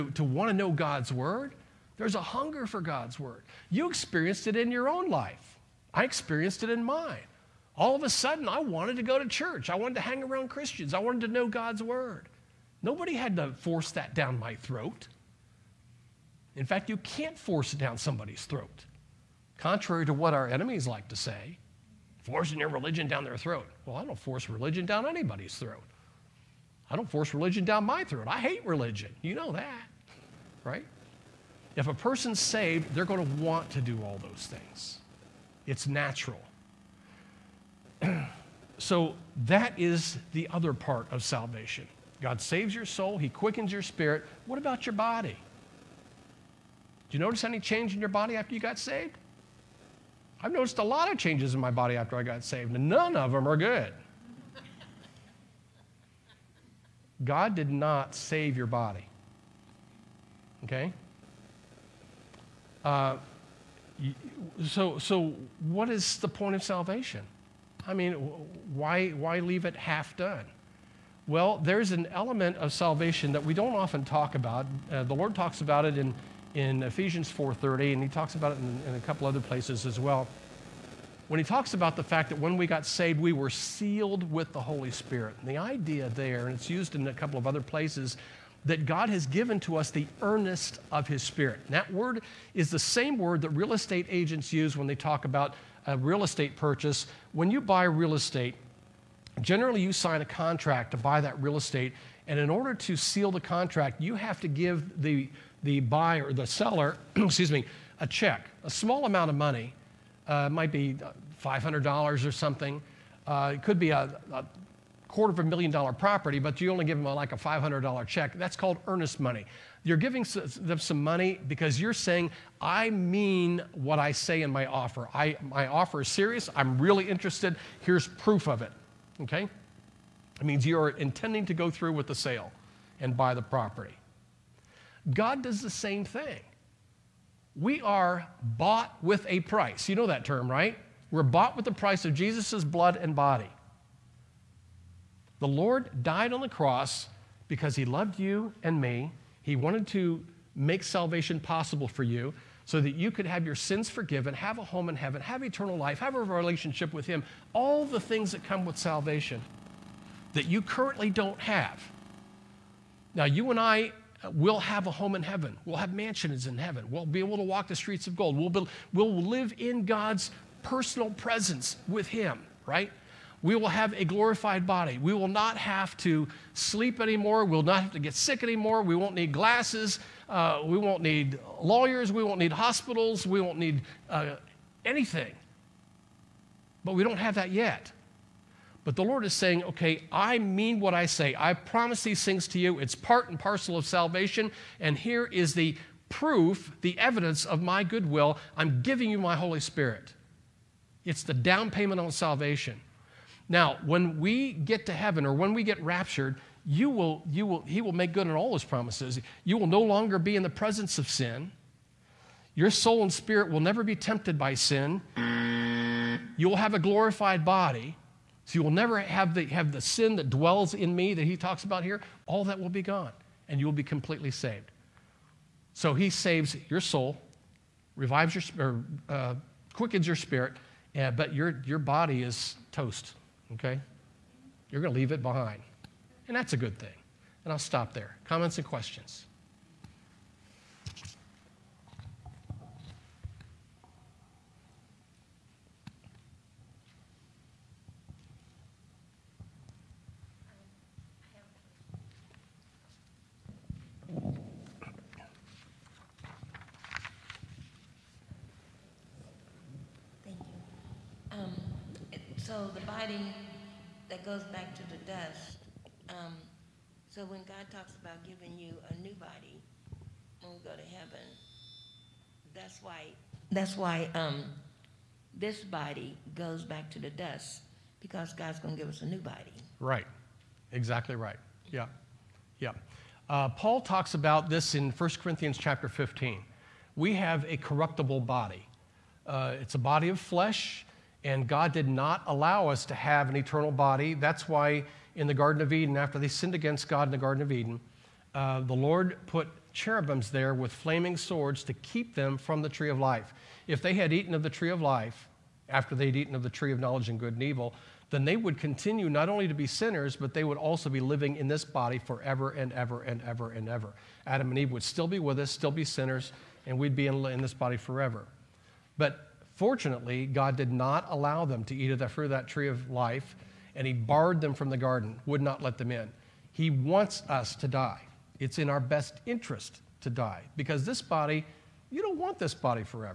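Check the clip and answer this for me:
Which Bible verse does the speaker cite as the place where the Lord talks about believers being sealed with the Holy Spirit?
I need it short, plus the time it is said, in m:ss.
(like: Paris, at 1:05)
Ephesians 4:30, at 1:16.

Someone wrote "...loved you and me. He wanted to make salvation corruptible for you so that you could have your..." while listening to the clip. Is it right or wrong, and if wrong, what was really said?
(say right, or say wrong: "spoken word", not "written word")
wrong: "possible", not "corruptible".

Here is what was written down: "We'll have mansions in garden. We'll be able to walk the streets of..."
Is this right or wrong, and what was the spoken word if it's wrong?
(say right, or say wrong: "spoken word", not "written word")
wrong: "heaven", not "garden".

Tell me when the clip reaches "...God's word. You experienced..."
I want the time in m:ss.
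0:02.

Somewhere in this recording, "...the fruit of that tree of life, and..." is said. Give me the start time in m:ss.
5:21.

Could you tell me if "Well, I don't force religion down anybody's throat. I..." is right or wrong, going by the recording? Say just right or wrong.
right.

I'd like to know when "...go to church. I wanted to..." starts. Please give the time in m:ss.
0:09.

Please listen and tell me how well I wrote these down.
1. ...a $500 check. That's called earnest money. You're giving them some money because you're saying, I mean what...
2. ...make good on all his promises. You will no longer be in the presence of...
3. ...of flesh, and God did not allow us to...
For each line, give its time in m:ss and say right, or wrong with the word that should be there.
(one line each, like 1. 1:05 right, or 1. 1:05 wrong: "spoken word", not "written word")
1. 1:57 right
2. 3:27 right
3. 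4:50 right.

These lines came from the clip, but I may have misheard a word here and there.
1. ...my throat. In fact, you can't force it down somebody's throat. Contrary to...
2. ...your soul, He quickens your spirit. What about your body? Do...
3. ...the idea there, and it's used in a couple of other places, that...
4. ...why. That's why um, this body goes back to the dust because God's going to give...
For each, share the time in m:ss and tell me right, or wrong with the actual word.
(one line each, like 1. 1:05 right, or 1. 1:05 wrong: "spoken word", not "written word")
1. 0:14 right
2. 0:42 right
3. 1:25 right
4. 4:32 right.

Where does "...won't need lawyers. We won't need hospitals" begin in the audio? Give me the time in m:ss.
3:00.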